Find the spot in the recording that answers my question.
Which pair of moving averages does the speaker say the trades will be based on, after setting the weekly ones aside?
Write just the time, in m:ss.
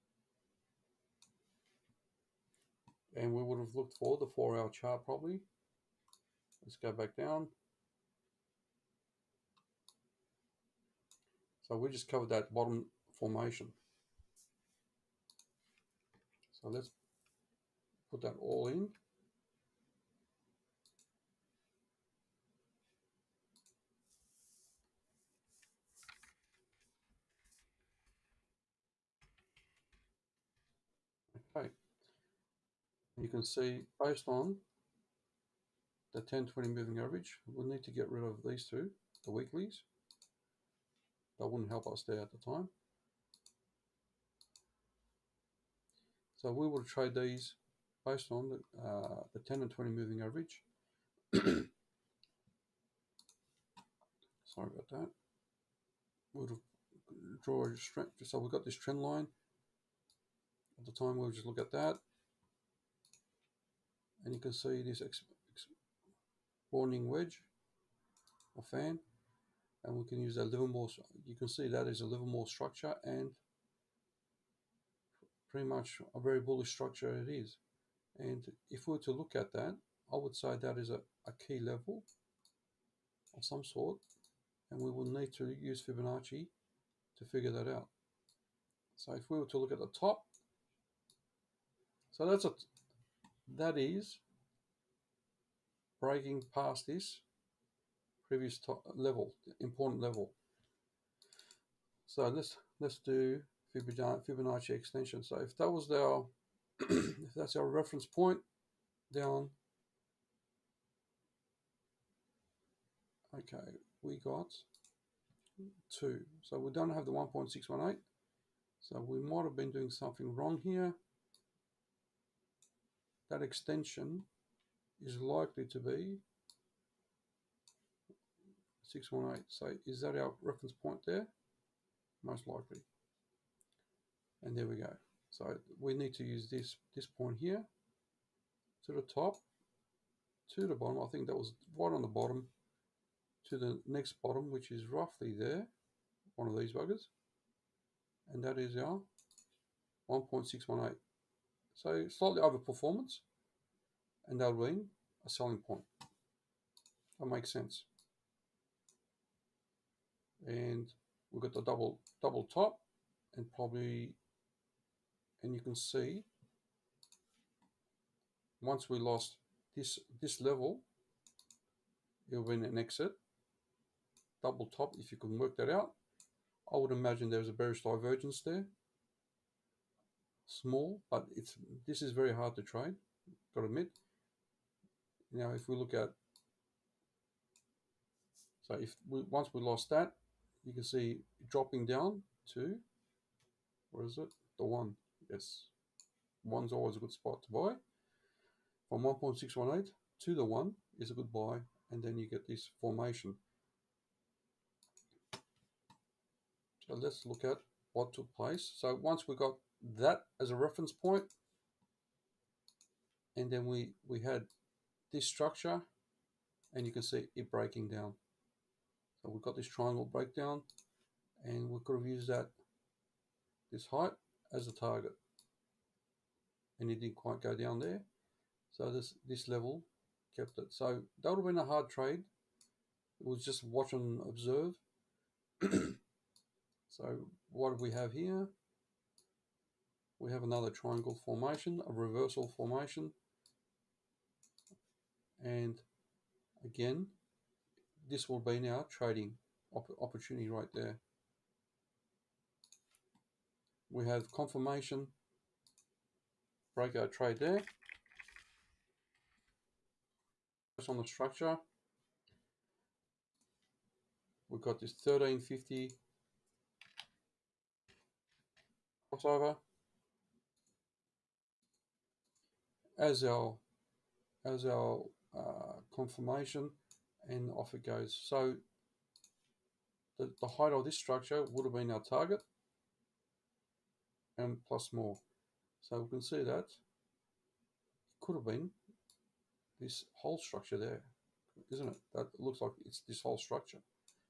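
0:49.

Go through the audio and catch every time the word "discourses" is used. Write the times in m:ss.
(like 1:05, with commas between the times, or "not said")
not said.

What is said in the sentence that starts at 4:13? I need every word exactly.
We have confirmation breakout trade there.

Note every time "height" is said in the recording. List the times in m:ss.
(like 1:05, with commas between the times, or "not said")
3:43, 4:40.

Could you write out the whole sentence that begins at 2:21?
I think that was right on the bottom to the next bottom, which is roughly there, one of these buggers.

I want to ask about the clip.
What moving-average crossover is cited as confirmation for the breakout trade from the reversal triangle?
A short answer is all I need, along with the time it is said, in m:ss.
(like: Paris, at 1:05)
1350 crossover, at 4:25.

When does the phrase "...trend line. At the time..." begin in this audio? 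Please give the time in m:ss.
0:58.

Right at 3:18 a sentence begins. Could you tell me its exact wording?
From 1.618 to the one is a good buy, and then you get this formation.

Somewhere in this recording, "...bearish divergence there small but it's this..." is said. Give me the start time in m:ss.
2:57.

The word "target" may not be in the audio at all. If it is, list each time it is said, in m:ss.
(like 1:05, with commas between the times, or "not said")
3:44, 4:42.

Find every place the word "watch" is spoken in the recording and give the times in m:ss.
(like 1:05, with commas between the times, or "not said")
3:53.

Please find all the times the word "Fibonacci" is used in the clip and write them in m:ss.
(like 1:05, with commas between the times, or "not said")
1:25, 1:43.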